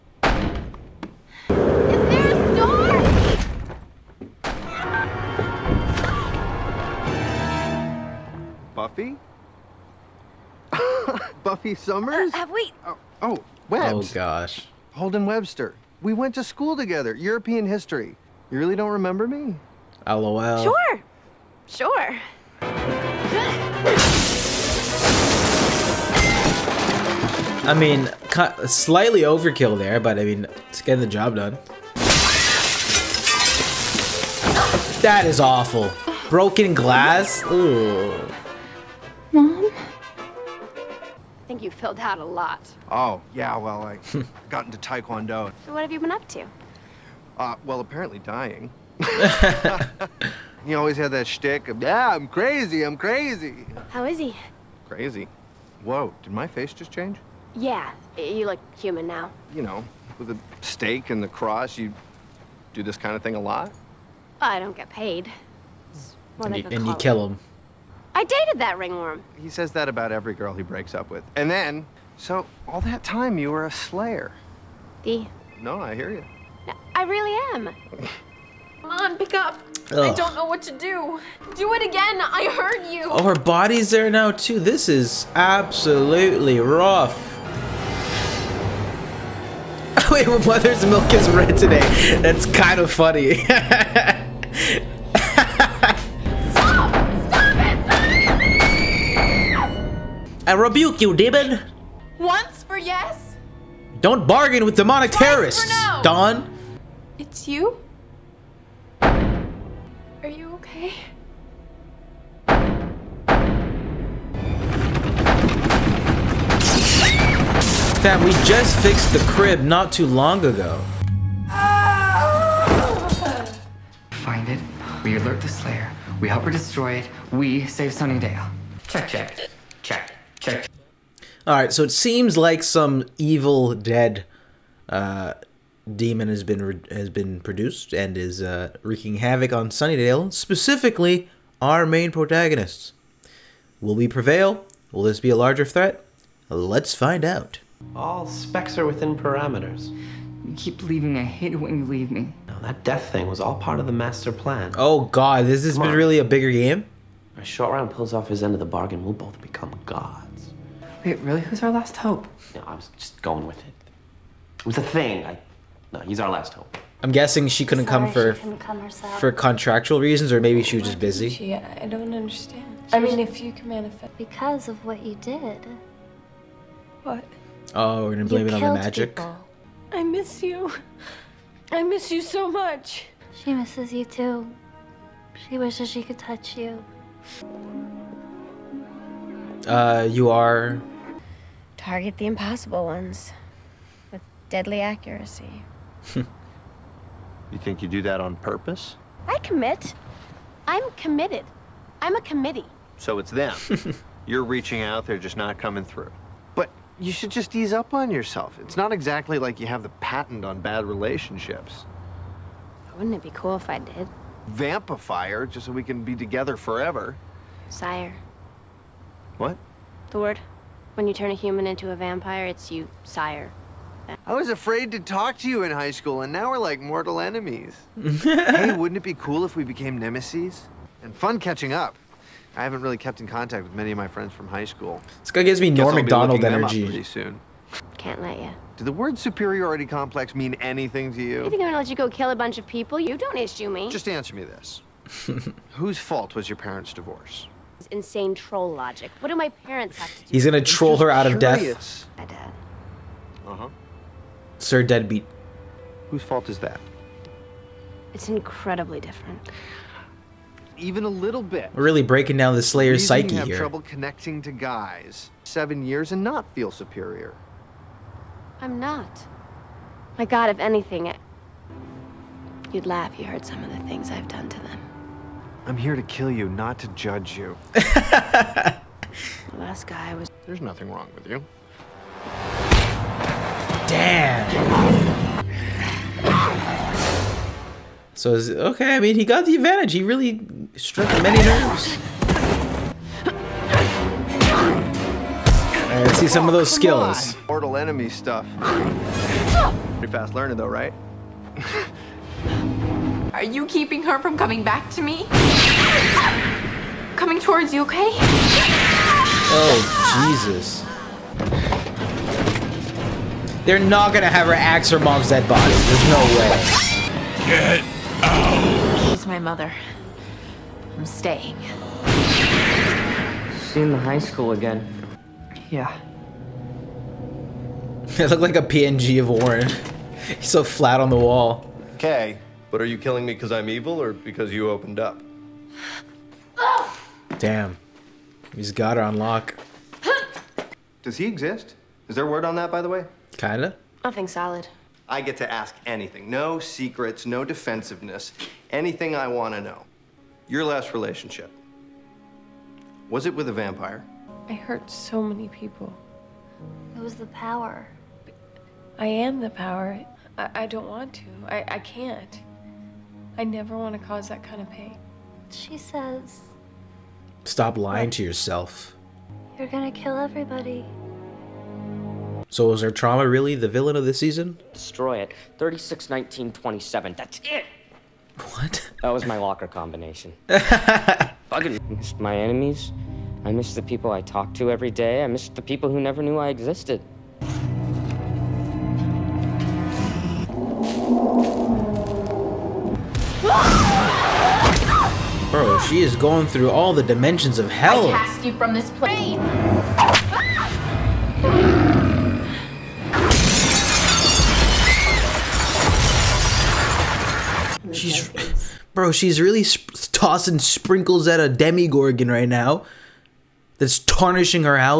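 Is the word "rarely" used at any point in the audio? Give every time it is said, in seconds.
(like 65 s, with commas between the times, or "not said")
not said.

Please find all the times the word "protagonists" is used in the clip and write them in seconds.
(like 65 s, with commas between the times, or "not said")
142 s.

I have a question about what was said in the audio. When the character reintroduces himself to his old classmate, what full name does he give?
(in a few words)
Holden Webster.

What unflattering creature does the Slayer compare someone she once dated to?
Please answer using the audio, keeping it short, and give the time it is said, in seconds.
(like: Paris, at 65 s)
ringworm, at 68 s.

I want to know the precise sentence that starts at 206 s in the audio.
But you should just ease up on yourself.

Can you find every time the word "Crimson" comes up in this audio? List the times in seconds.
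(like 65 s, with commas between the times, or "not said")
not said.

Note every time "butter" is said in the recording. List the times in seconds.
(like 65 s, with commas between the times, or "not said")
not said.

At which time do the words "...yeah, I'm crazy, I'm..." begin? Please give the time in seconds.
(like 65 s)
51 s.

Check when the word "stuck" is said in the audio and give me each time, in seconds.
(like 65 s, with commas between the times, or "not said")
not said.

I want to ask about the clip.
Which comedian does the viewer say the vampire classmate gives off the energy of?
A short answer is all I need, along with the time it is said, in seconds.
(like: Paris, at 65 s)
Norm Macdonald, at 235 s.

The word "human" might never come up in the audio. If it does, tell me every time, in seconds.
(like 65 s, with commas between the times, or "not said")
58 s, 221 s.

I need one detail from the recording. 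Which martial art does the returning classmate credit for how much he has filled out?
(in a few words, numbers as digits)
Taekwondo.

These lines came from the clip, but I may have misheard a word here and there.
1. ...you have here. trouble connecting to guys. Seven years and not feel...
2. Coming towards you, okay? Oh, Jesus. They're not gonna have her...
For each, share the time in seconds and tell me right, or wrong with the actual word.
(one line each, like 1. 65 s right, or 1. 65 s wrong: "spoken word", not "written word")
1. 263 s right
2. 307 s right.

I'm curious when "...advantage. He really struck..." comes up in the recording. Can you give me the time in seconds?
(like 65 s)
289 s.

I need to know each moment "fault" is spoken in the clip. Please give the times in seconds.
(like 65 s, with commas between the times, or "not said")
245 s, 256 s.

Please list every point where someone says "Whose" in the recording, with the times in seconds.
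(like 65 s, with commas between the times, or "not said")
245 s, 256 s.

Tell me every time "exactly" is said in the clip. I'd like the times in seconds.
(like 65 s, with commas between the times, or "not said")
208 s.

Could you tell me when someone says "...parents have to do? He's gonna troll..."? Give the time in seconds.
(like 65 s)
249 s.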